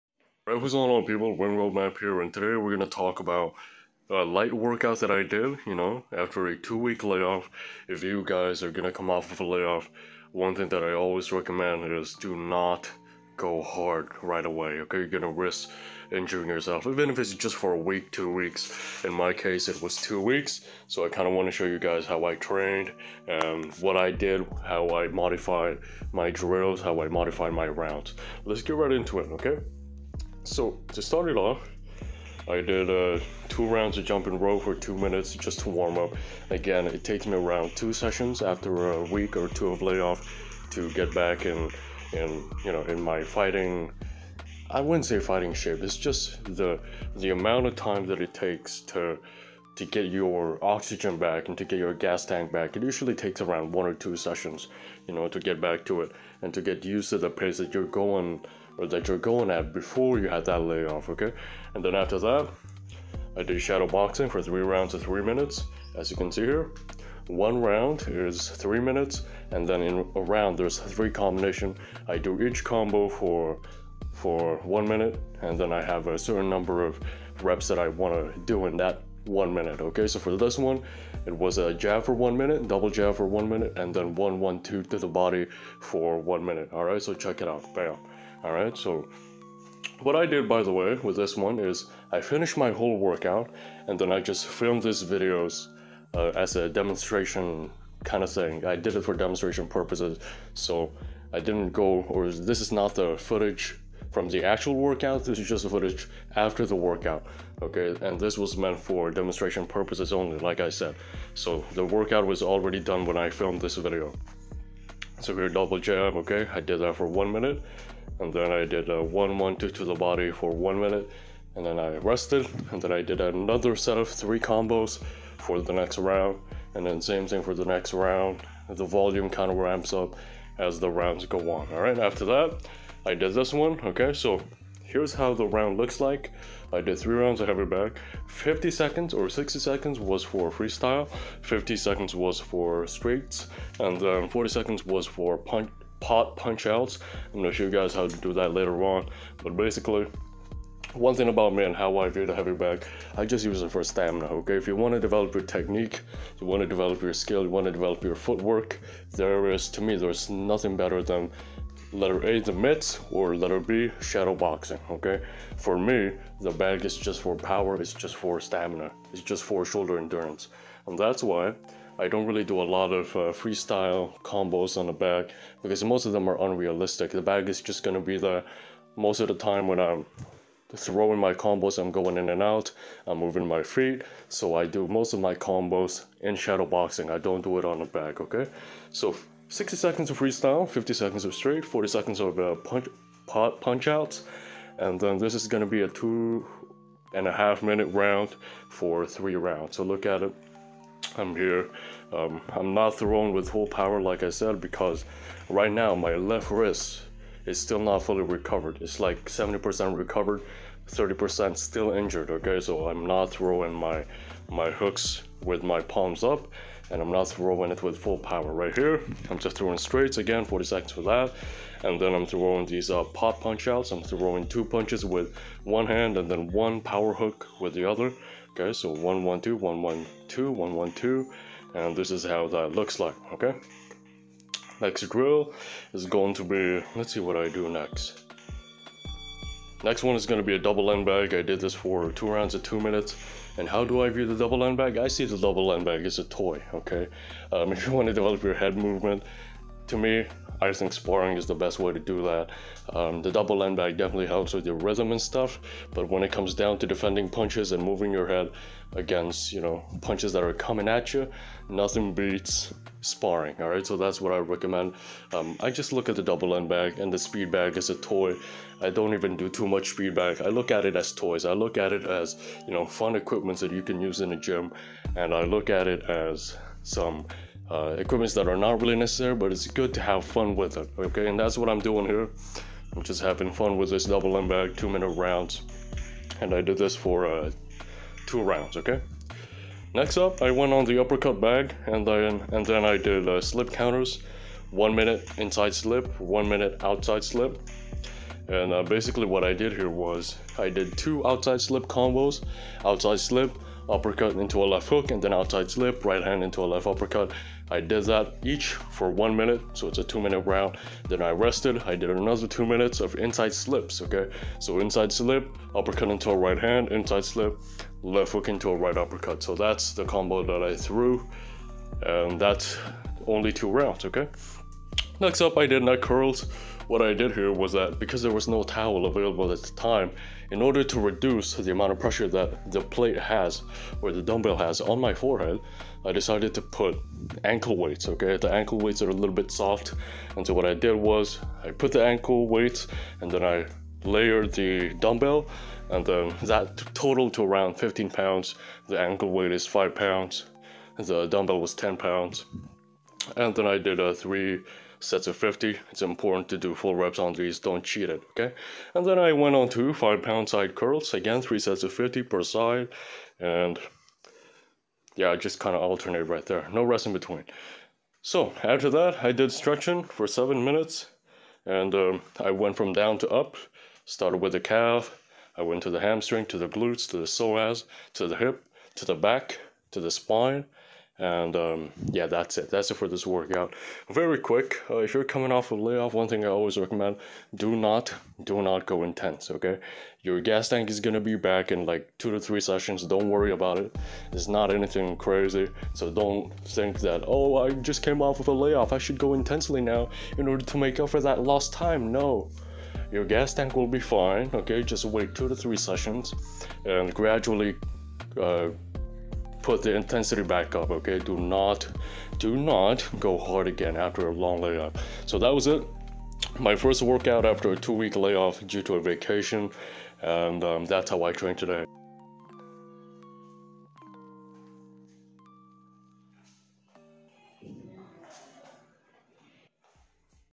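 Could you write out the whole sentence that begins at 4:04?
I see the double end bag as a toy, okay?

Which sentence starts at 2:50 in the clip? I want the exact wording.
And that's why I don't really do a lot of uh, freestyle combos on the bag because most of them are unrealistic.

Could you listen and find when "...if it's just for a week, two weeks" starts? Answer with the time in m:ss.
0:17.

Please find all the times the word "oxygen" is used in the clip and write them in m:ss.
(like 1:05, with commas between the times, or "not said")
0:50.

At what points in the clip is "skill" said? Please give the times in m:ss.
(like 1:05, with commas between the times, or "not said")
2:37.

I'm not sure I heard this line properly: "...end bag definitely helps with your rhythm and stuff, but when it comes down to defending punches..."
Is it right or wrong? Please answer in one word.
right.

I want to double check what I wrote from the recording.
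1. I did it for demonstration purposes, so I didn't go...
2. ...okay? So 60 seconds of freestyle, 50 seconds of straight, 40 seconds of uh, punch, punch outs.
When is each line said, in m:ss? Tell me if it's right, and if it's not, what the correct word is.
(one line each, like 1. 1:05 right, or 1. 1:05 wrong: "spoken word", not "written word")
1. 1:38 right
2. 3:08 right.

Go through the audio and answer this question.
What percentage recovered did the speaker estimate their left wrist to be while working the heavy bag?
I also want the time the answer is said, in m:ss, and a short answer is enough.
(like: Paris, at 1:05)
70%, at 3:29.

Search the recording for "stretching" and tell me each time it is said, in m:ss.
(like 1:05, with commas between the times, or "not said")
6:09.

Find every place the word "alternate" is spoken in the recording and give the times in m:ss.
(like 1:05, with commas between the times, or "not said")
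6:05.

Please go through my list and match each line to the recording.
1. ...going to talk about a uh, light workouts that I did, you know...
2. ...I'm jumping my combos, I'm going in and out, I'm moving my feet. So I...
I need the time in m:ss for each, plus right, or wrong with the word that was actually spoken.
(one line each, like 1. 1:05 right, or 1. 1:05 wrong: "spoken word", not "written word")
1. 0:02 right
2. 2:59 wrong: "throwing", not "jumping".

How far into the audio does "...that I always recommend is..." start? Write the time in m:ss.
0:10.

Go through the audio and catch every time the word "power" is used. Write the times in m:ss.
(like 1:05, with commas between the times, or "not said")
2:47, 3:23, 3:38, 3:46.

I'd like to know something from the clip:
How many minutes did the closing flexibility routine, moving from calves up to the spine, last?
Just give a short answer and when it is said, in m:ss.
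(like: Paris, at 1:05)
7 minutes, at 6:10.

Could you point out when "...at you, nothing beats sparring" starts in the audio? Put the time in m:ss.
4:20.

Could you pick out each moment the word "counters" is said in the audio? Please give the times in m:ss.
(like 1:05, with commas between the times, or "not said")
4:53.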